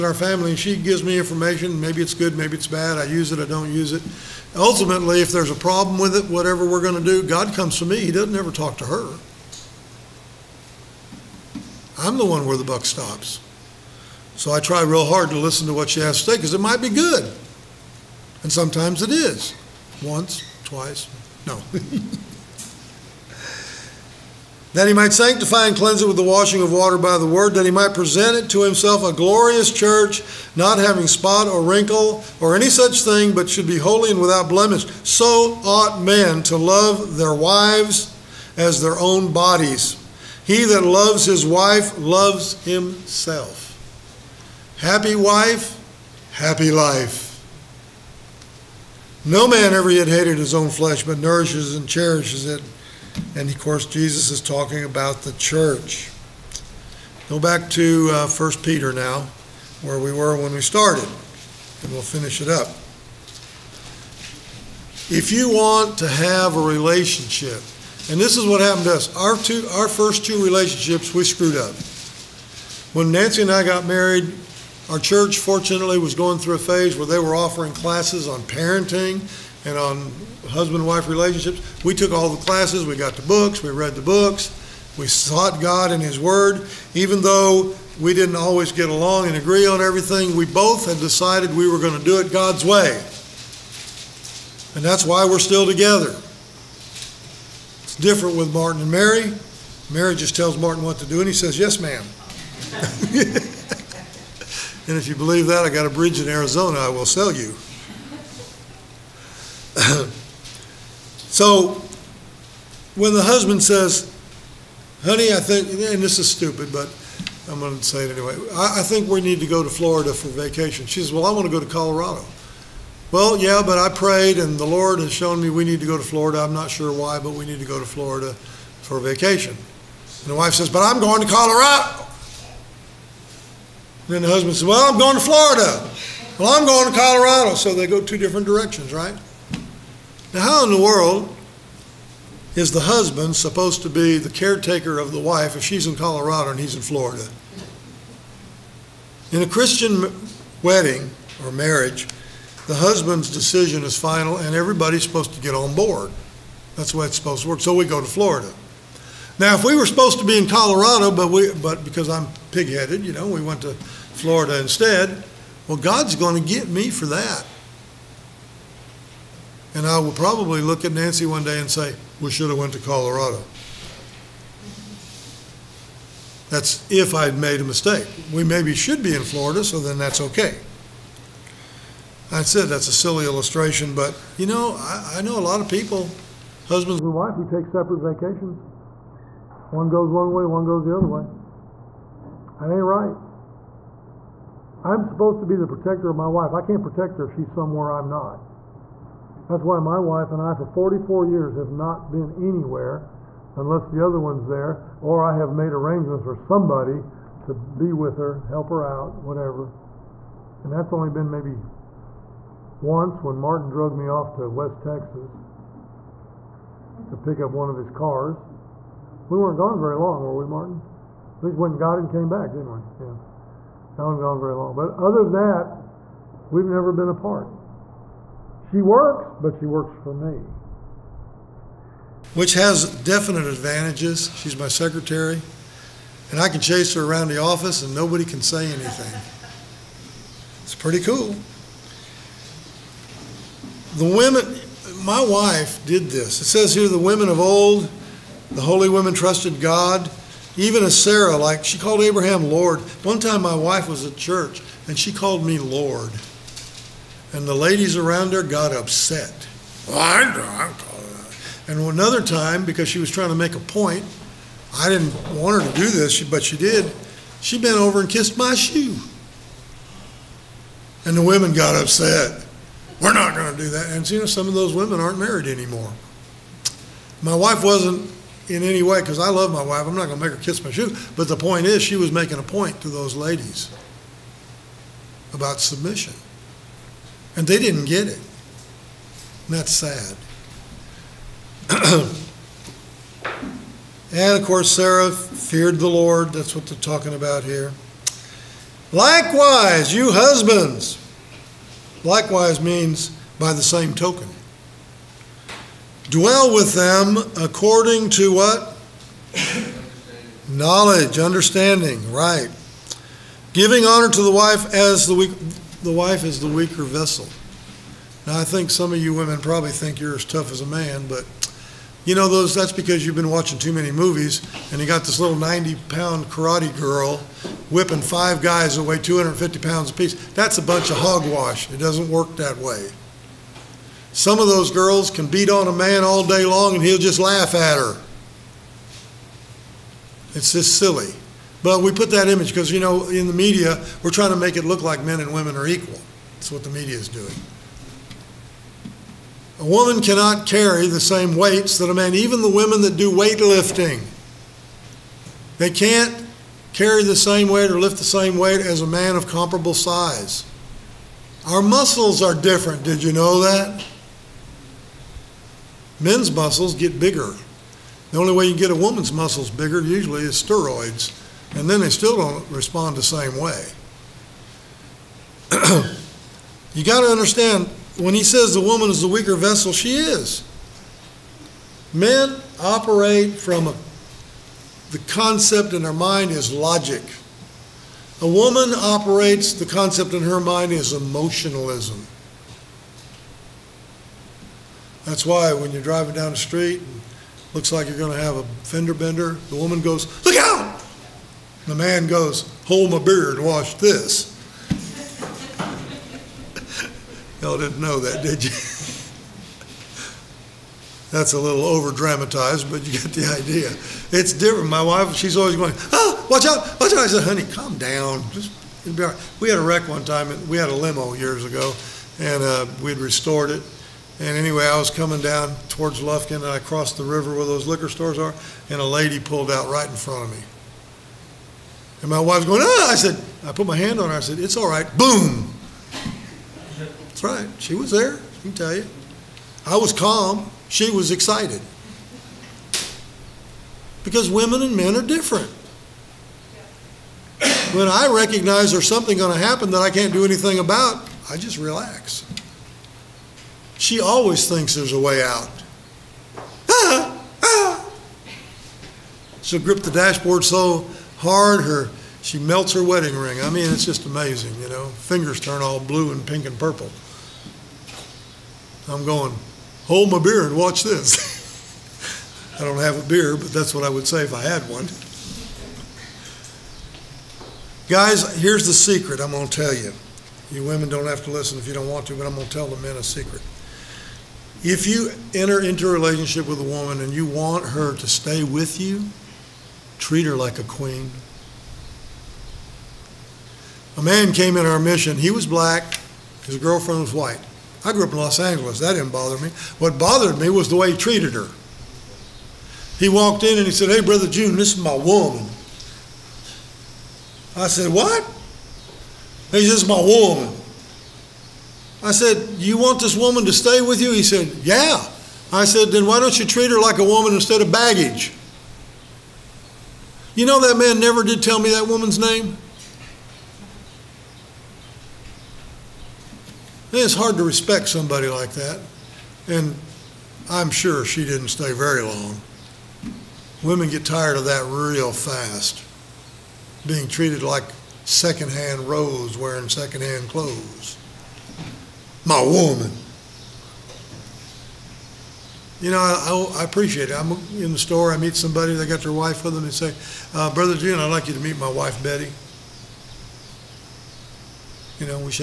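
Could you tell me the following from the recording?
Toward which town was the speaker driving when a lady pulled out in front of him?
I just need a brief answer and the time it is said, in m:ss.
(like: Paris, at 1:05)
Lufkin, at 7:06.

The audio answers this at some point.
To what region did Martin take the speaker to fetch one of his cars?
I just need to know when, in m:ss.
3:34.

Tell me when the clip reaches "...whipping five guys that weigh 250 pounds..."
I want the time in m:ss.
5:27.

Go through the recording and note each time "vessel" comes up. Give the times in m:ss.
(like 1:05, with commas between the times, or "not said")
5:16, 6:19.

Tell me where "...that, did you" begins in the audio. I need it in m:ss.
6:47.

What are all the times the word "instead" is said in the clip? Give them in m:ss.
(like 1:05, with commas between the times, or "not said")
2:44, 8:37.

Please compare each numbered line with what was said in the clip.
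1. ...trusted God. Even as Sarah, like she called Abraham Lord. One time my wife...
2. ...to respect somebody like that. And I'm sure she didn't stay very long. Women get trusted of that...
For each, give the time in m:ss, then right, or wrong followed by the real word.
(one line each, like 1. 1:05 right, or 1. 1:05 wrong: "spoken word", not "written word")
1. 4:09 right
2. 8:47 wrong: "tired", not "trusted".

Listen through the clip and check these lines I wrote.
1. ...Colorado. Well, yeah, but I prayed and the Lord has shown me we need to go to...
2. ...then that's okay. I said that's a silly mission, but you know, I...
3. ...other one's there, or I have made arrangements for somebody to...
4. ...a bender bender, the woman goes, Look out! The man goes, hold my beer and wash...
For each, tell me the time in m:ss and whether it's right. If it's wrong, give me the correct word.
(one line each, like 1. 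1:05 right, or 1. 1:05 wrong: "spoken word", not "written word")
1. 2:01 right
2. 2:59 wrong: "illustration", not "mission"
3. 3:24 right
4. 6:38 wrong: "fender", not "bender".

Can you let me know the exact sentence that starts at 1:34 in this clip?
And that's why we're still together.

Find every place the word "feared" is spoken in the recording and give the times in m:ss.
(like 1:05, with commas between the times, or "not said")
4:55.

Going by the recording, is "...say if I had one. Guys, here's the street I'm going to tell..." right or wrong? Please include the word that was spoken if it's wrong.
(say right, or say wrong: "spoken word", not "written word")
wrong: "secret", not "street".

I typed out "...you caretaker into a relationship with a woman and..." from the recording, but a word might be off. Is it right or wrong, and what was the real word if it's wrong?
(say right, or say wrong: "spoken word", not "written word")
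wrong: "enter", not "caretaker".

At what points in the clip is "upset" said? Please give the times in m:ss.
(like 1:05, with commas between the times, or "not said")
4:18, 4:31.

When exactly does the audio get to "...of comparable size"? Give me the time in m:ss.
5:59.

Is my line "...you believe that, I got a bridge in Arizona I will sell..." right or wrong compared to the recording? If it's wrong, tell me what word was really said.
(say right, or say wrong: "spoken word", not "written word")
right.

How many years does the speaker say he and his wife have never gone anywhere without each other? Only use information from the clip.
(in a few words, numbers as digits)
44.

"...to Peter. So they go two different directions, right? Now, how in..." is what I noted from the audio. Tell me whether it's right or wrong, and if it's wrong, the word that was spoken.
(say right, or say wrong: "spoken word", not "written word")
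wrong: "Colorado", not "Peter".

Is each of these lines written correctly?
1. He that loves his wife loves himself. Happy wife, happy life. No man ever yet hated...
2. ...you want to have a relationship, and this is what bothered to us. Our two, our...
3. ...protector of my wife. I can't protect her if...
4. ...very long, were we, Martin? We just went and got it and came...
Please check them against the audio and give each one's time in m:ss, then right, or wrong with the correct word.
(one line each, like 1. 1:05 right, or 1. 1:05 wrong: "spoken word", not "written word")
1. 0:40 right
2. 1:05 wrong: "happened", not "bothered"
3. 3:15 right
4. 3:39 right.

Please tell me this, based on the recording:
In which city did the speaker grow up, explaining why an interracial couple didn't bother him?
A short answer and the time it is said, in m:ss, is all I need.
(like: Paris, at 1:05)
Los Angeles, at 8:18.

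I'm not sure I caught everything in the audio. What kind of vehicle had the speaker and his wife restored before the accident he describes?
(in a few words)
A limo.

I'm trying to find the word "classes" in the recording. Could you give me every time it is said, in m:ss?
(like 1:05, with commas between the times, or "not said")
1:17, 1:22.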